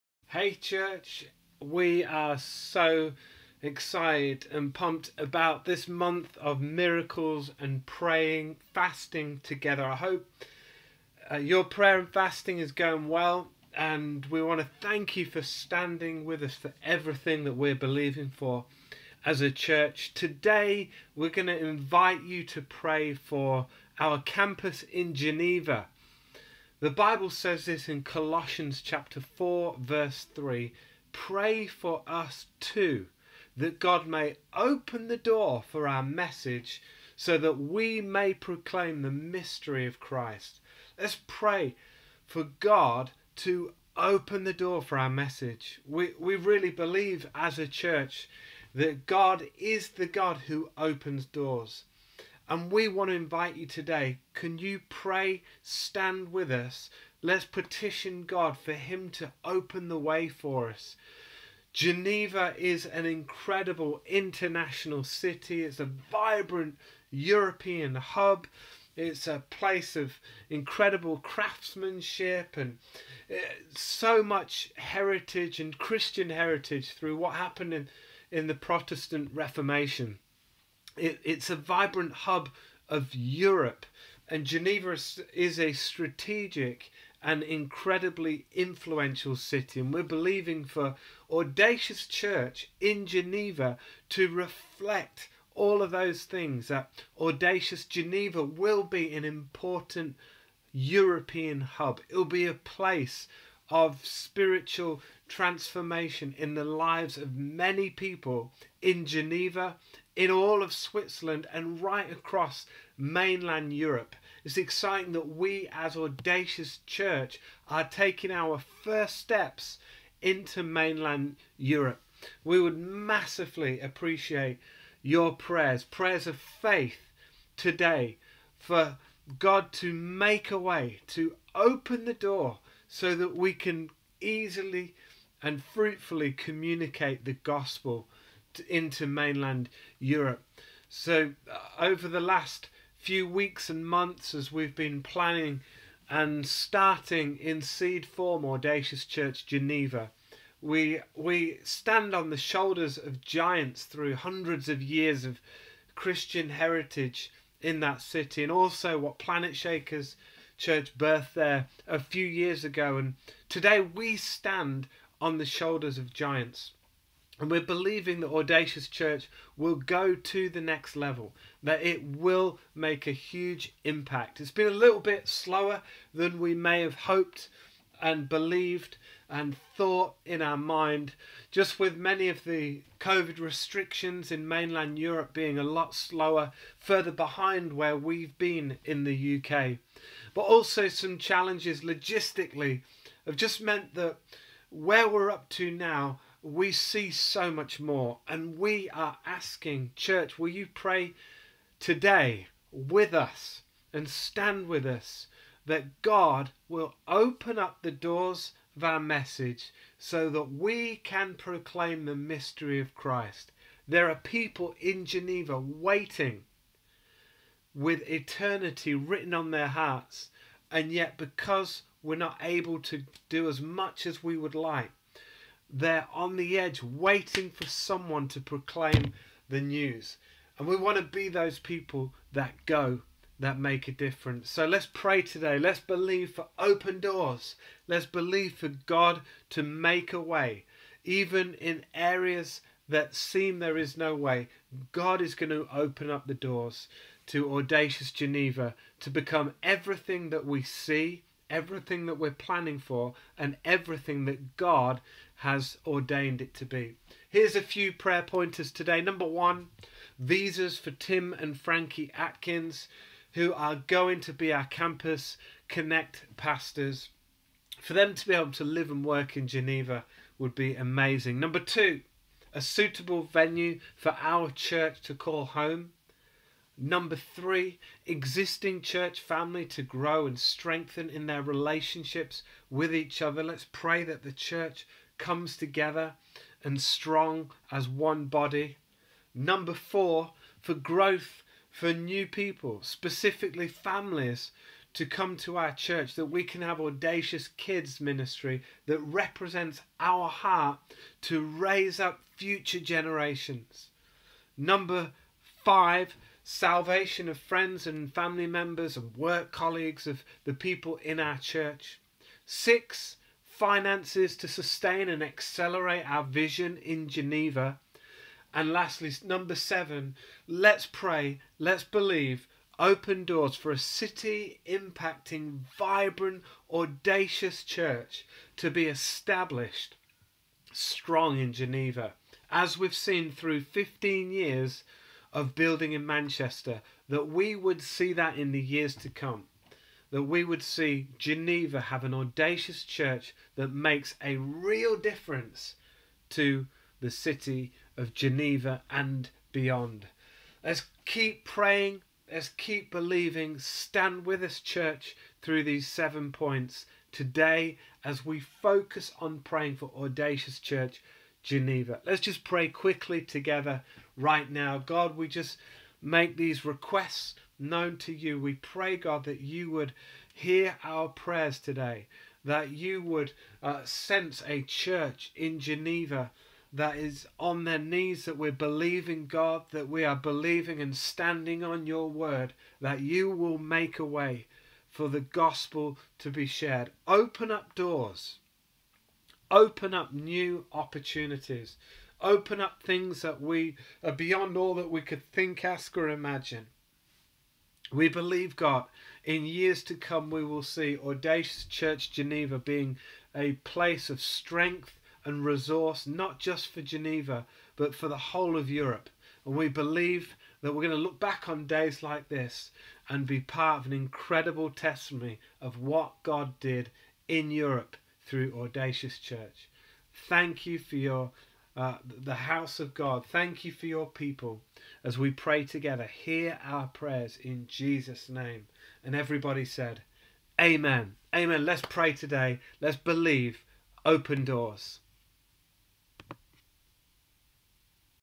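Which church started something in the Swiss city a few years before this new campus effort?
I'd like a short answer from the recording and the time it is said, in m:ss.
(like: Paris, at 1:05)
Planetshakers Church, at 2:39.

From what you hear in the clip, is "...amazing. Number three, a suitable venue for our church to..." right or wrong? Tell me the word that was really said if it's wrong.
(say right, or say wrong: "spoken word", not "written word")
wrong: "two", not "three".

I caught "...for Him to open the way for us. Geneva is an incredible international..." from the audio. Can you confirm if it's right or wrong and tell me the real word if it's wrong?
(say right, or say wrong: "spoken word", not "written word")
right.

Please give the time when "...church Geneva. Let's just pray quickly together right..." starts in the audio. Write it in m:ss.
6:00.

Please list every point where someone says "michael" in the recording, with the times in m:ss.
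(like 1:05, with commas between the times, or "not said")
not said.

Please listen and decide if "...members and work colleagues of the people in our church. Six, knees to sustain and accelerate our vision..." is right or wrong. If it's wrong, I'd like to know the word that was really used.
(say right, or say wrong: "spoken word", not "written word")
wrong: "finances", not "knees".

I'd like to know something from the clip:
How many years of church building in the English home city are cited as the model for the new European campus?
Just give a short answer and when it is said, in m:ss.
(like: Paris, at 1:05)
15, at 5:33.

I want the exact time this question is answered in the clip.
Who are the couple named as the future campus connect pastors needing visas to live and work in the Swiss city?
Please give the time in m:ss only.
4:20.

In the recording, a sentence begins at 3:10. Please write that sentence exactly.
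But also some challenges logistically have just meant that where we're up to now we see so much more.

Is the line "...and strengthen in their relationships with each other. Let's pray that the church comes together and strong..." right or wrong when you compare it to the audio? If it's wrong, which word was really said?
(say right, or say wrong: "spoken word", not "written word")
right.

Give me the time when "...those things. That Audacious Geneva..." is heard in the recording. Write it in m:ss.
1:35.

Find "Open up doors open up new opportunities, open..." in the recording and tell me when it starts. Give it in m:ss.
6:27.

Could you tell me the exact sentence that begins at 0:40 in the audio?
Let's pray for God to open the door for our message.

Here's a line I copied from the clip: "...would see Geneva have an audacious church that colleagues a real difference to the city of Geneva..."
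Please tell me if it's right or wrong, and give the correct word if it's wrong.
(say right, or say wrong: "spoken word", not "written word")
wrong: "makes", not "colleagues".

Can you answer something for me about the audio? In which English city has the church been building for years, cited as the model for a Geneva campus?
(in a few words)
Manchester.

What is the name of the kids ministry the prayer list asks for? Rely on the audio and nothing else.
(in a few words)
Audacious Kids.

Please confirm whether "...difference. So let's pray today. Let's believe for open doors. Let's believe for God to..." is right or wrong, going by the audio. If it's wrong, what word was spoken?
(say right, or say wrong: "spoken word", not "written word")
right.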